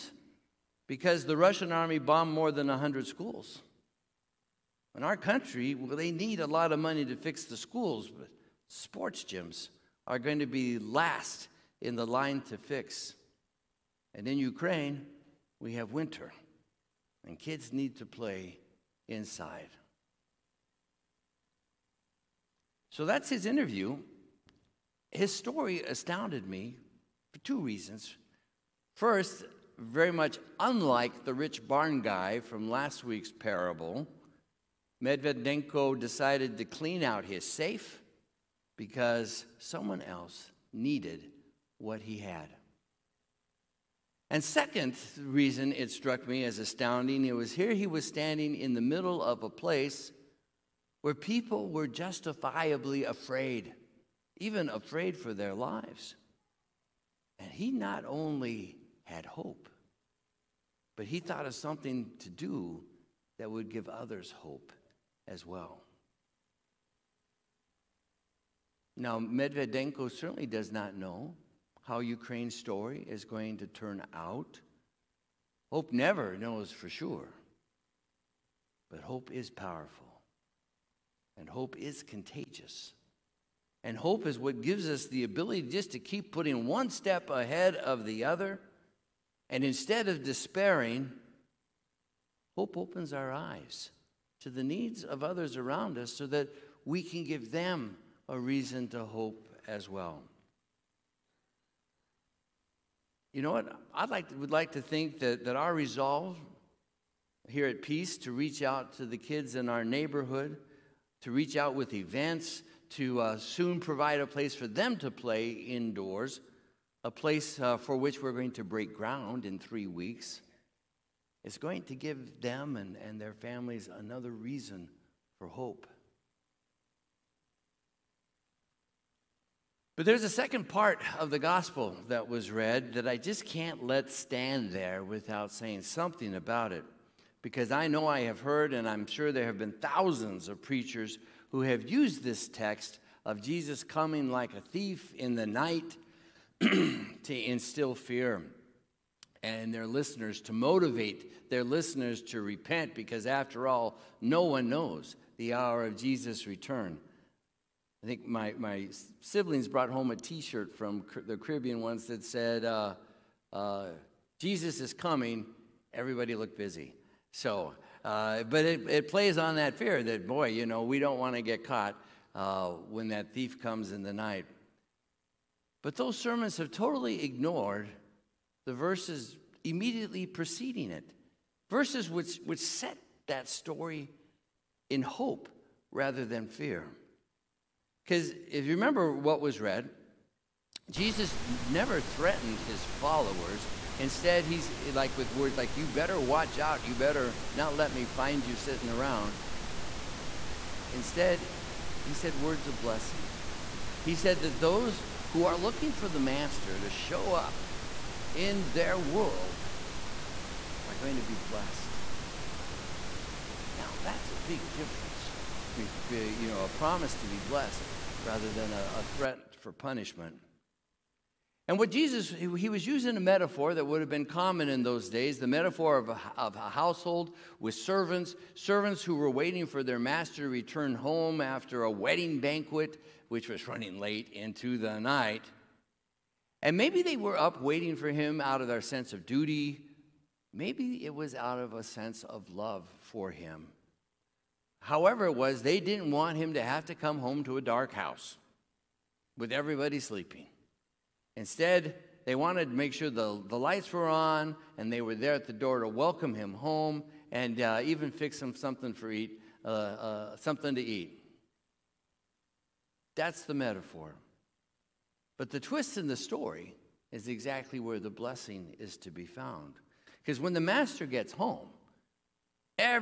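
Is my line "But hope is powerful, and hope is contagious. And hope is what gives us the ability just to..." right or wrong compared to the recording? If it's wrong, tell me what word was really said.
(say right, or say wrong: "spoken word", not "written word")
right.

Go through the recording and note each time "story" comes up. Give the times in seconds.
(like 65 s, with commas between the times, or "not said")
25 s, 72 s, 183 s, 266 s.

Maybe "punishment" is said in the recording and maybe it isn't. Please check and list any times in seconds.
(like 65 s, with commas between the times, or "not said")
219 s.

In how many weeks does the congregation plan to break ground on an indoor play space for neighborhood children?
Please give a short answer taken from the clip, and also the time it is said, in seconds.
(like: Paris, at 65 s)
3, at 119 s.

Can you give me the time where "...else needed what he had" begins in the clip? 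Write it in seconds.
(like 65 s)
40 s.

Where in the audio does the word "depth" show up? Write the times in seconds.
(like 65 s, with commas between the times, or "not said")
not said.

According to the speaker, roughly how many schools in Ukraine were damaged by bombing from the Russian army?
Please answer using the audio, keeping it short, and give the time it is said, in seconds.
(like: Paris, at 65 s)
more than 100, at 2 s.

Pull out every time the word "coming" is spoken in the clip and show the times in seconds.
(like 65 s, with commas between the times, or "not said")
143 s, 164 s.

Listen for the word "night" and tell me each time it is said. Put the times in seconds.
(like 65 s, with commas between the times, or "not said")
145 s, 174 s, 235 s.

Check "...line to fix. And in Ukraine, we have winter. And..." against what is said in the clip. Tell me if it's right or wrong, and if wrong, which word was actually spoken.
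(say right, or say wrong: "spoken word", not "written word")
right.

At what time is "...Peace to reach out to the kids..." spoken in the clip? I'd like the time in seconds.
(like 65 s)
107 s.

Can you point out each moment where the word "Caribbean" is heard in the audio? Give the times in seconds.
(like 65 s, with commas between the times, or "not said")
161 s.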